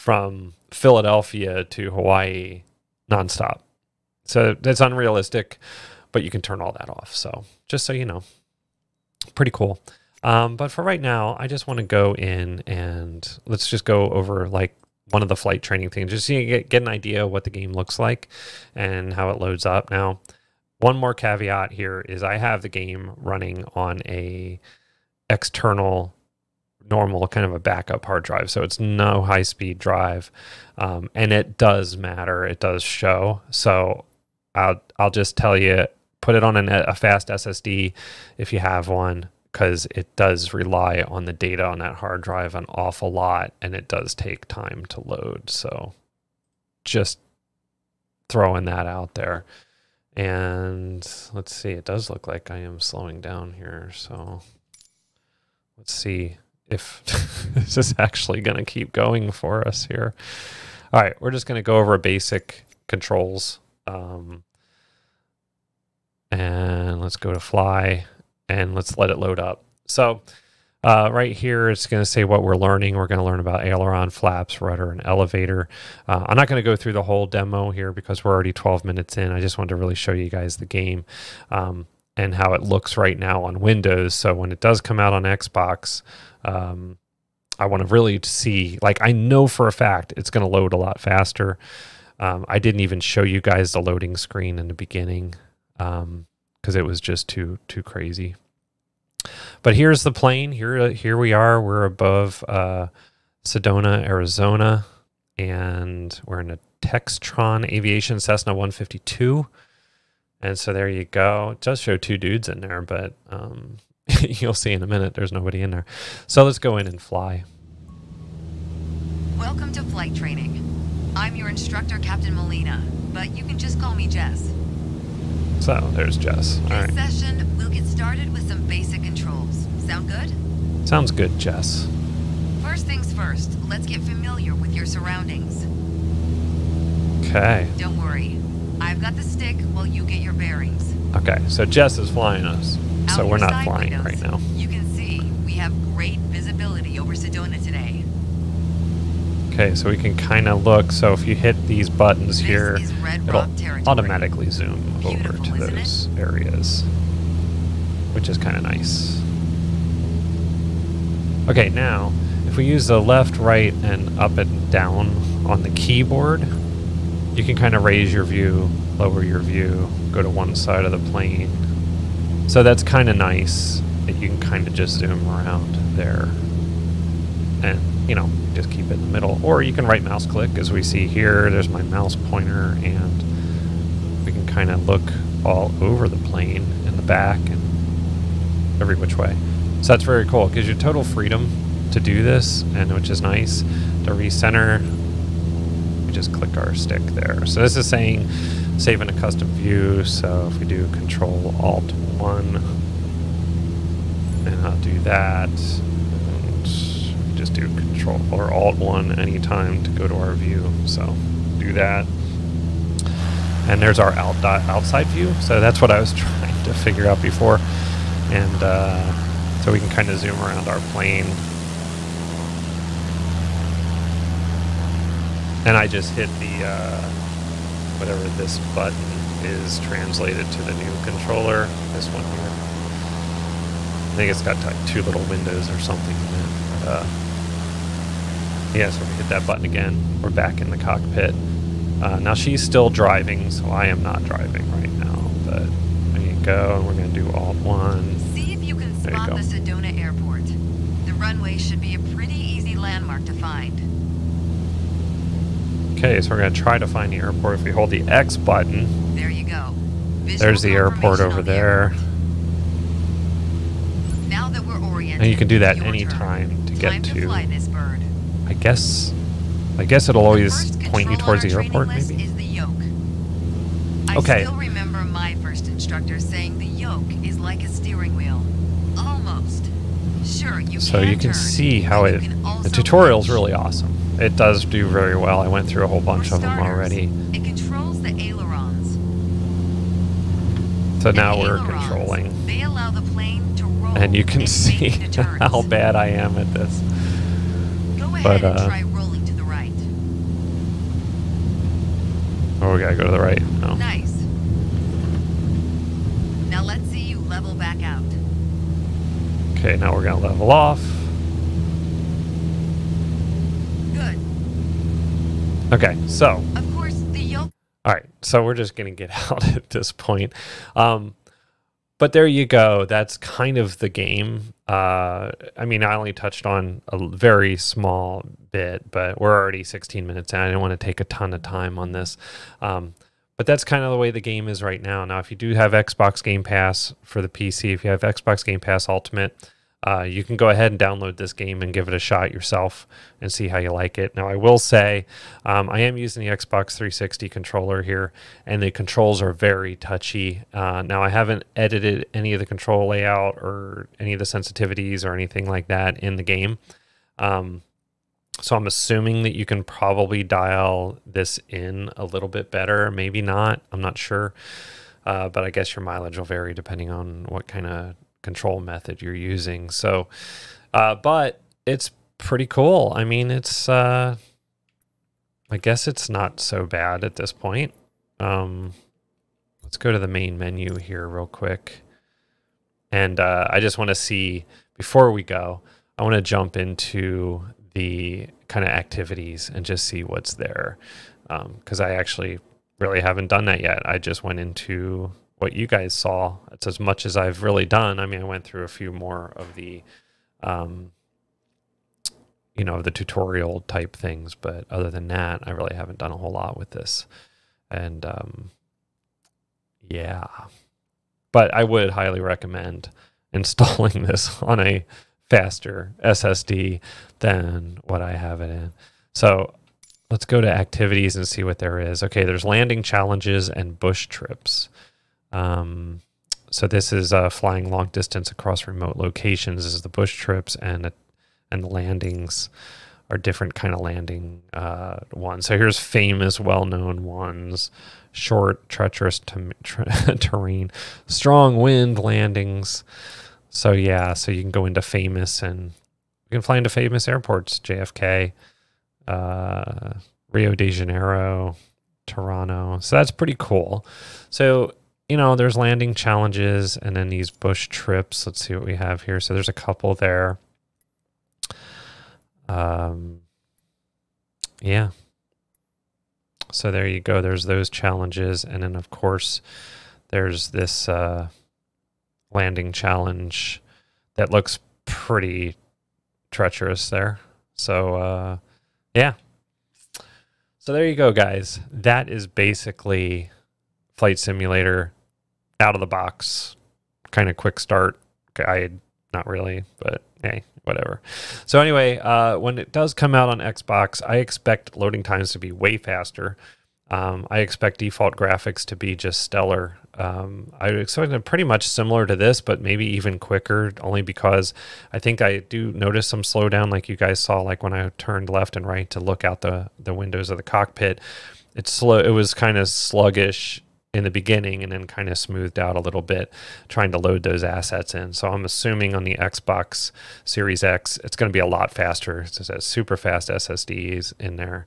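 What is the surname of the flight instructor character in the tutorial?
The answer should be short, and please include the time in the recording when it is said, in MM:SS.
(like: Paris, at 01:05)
Molina, at 02:02.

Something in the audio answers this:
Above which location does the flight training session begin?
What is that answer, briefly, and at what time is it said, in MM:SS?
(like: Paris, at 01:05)
Sedona, Arizona, at 01:43.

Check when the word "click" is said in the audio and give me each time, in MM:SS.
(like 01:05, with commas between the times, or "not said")
03:00, 03:16.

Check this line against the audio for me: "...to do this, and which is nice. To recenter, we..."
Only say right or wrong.
right.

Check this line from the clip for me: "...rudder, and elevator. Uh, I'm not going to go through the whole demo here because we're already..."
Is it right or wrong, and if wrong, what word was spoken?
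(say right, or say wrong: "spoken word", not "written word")
right.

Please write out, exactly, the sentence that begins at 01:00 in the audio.
All right, we're just going to go over basic controls.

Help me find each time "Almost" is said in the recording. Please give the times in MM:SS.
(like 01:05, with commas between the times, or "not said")
04:38.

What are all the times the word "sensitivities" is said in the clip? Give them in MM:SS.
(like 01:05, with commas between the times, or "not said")
05:54.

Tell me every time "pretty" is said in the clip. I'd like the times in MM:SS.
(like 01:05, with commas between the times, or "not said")
00:09, 04:12, 06:12, 07:33, 07:54, 08:21.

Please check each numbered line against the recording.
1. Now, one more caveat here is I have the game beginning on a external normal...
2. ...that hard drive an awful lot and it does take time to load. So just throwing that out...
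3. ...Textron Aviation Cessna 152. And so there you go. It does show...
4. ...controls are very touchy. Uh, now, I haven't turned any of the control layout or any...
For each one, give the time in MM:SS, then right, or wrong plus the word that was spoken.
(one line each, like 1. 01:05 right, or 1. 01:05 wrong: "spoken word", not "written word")
1. 00:19 wrong: "running", not "beginning"
2. 00:41 right
3. 01:46 right
4. 05:48 wrong: "edited", not "turned".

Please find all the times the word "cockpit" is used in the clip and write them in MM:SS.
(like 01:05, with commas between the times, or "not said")
04:00, 08:30.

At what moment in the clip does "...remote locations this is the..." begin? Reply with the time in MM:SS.
07:08.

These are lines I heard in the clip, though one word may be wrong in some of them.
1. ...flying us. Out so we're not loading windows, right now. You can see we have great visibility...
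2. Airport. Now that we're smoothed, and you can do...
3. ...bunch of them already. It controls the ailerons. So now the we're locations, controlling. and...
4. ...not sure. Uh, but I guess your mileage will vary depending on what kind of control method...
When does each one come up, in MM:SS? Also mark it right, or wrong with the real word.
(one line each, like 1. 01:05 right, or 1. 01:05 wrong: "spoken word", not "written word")
1. 02:22 wrong: "flying", not "loading"
2. 04:21 wrong: "oriented", not "smoothed"
3. 04:46 wrong: "ailerons", not "locations"
4. 06:03 right.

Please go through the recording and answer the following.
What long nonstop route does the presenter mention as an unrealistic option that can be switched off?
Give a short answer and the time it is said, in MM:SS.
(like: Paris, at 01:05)
Philadelphia to Hawaii, at 00:00.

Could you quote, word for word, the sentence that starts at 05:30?
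I didn't want to take a ton of time on this.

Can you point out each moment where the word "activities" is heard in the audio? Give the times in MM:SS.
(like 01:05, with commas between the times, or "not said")
06:28, 07:00.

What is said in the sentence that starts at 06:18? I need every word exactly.
Um, let's go to the main menu here real quick.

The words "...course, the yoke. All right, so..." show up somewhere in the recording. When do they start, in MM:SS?
05:16.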